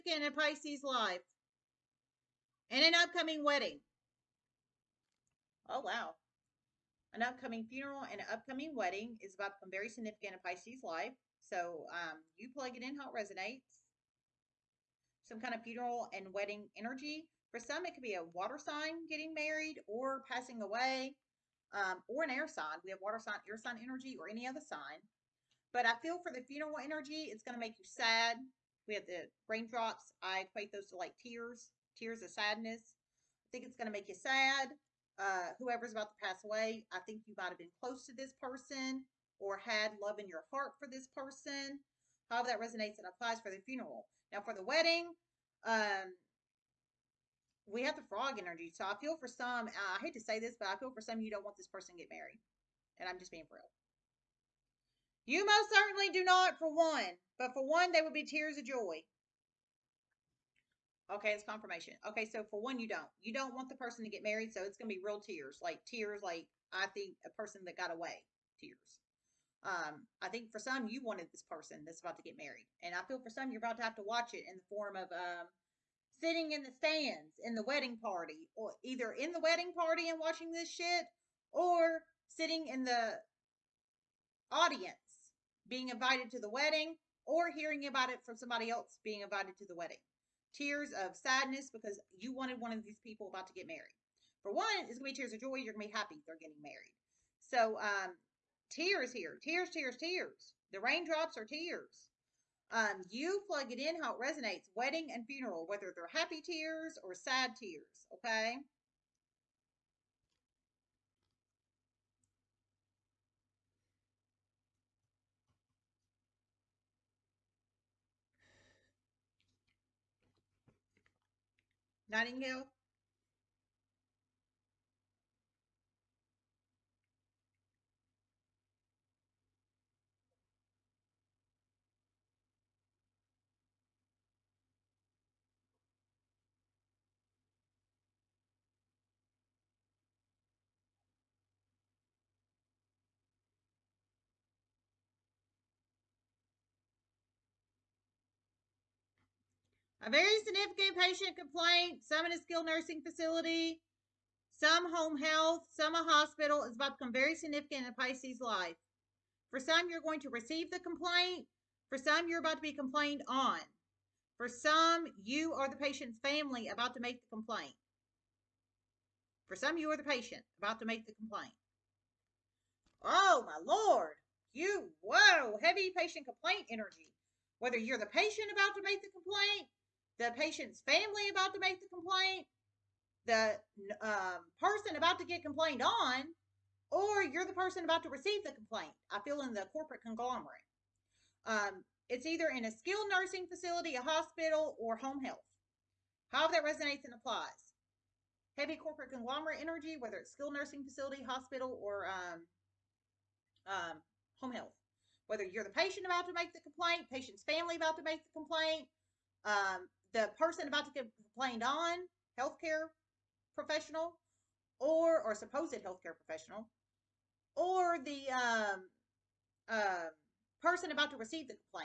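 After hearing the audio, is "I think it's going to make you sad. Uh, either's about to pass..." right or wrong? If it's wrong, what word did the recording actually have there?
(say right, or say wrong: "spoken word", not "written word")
wrong: "whoever", not "either".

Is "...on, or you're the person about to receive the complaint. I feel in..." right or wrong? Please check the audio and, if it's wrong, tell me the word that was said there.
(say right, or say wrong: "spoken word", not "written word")
right.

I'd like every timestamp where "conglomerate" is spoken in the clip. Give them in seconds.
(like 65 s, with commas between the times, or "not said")
190 s, 199 s.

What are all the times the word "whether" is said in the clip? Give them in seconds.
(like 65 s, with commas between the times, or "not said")
105 s, 177 s, 199 s, 205 s.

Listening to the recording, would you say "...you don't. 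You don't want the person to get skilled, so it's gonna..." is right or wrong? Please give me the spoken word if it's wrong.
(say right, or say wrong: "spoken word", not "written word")
wrong: "married", not "skilled".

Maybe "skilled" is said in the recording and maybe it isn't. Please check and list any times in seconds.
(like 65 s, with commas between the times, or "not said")
152 s, 192 s, 200 s.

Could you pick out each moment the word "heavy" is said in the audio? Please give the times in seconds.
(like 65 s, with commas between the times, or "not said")
175 s, 198 s.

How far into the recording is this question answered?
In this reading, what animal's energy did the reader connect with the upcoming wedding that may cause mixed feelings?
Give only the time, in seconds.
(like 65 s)
48 s.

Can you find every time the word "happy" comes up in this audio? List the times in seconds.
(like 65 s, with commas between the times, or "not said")
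95 s, 106 s.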